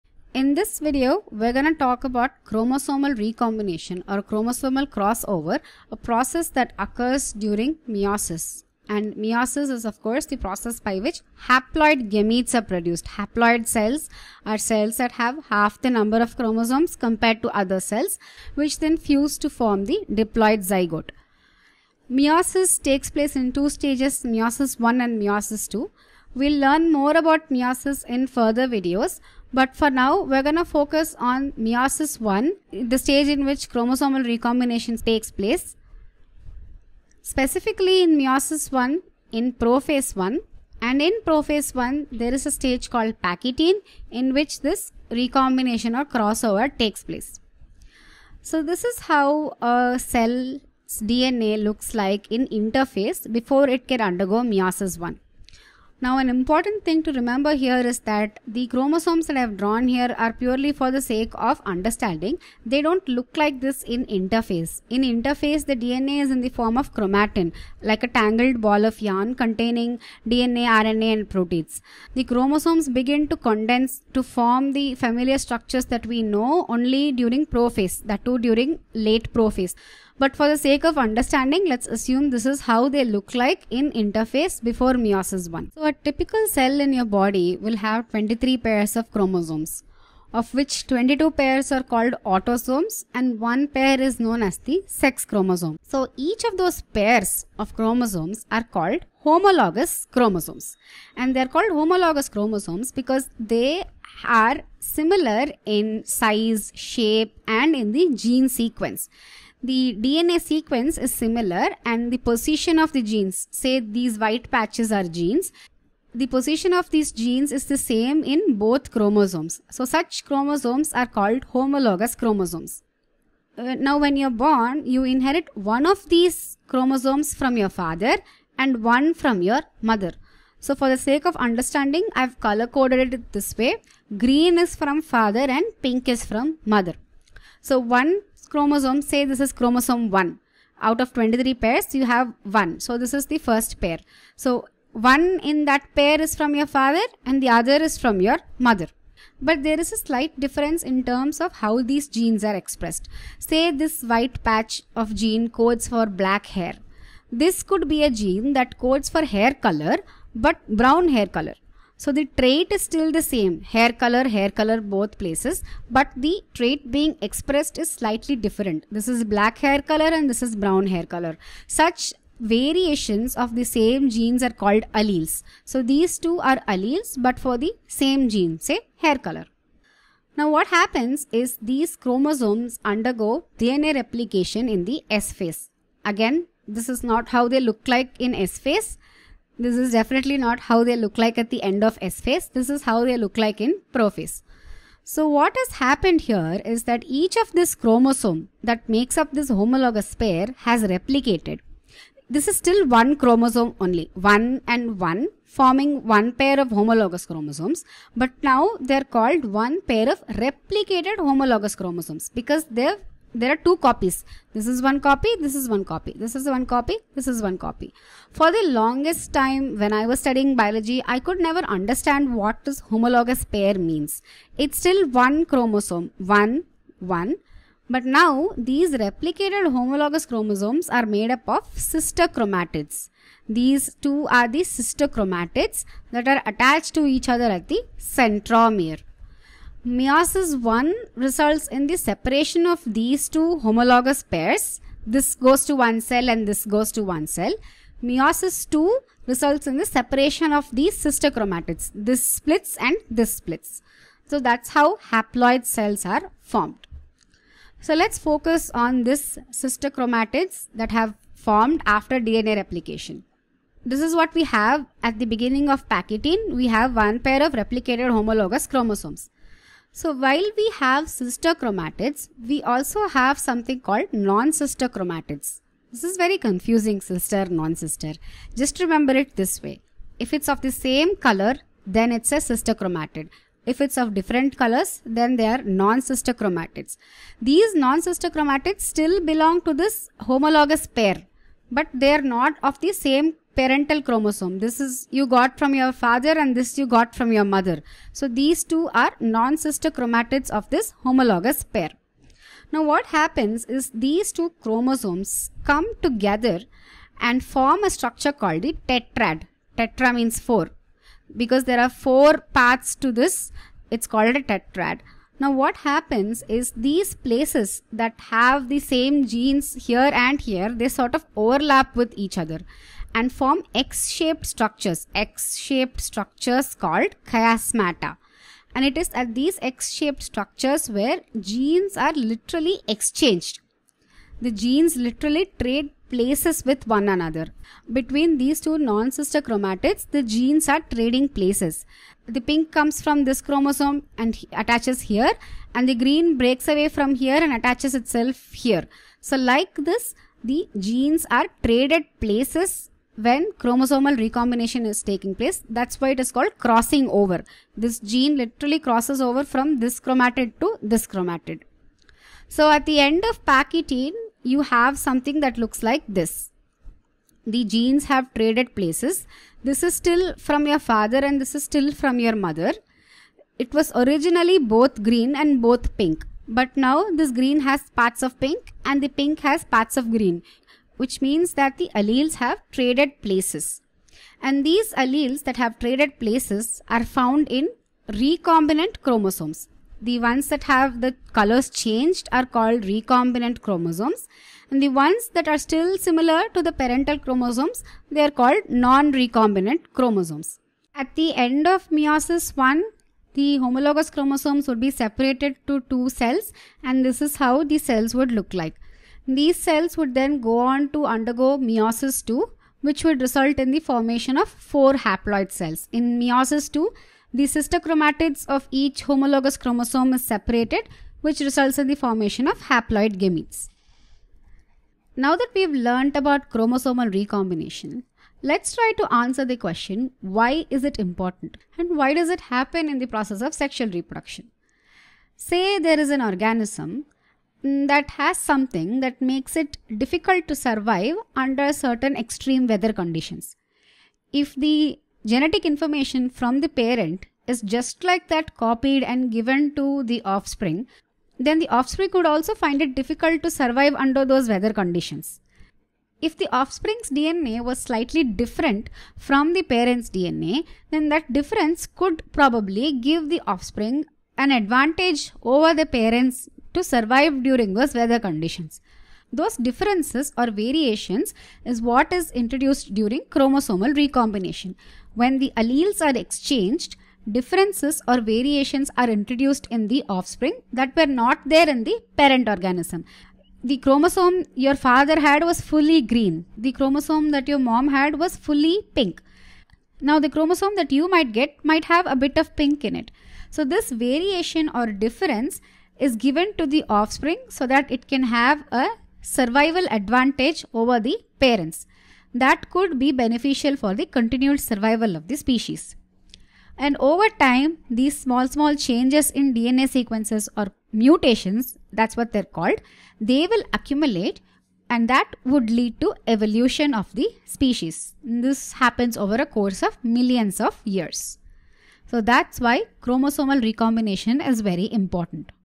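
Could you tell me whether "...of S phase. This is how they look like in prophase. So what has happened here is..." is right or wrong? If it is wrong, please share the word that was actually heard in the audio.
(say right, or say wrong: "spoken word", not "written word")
right.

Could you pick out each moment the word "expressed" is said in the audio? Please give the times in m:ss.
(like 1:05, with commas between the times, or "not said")
2:32, 2:47.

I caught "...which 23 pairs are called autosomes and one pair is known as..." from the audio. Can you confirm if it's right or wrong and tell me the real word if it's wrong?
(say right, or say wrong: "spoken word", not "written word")
wrong: "22", not "23".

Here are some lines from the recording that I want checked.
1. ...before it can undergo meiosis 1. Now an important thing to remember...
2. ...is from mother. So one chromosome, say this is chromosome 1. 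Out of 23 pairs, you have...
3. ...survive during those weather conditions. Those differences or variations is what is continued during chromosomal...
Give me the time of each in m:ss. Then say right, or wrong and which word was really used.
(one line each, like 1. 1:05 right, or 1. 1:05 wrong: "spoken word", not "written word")
1. 0:53 right
2. 2:16 right
3. 7:46 wrong: "introduced", not "continued".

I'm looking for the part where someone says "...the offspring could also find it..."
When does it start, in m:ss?
7:31.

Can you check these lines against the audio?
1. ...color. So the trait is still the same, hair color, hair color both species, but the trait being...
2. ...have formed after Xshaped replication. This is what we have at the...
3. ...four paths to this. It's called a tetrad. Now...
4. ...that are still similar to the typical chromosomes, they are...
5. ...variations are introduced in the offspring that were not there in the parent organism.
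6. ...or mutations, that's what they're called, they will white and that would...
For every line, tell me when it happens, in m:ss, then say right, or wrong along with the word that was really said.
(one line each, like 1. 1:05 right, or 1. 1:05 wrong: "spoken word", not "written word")
1. 2:41 wrong: "places", not "species"
2. 4:20 wrong: "DNA", not "Xshaped"
3. 5:11 right
4. 6:35 wrong: "parental", not "typical"
5. 7:58 right
6. 8:30 wrong: "accumulate", not "white".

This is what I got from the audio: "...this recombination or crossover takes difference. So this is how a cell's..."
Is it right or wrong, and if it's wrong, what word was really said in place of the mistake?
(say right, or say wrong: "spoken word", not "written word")
wrong: "place", not "difference".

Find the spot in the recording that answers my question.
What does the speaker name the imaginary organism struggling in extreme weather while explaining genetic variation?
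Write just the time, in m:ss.
7:17.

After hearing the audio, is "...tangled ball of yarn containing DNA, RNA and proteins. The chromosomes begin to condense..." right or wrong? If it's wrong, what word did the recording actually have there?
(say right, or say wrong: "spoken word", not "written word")
right.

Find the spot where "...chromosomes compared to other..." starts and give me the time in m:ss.
0:16.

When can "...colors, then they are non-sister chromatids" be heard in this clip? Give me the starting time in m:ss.
4:44.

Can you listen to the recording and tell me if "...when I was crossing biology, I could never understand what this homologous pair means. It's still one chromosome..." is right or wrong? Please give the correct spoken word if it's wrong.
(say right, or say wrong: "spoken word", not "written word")
wrong: "studying", not "crossing".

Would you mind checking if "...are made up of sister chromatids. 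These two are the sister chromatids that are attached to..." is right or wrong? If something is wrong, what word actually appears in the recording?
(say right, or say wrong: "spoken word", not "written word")
right.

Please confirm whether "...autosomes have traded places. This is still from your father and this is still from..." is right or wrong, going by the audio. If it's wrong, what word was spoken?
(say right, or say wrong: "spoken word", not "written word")
wrong: "genes", not "autosomes".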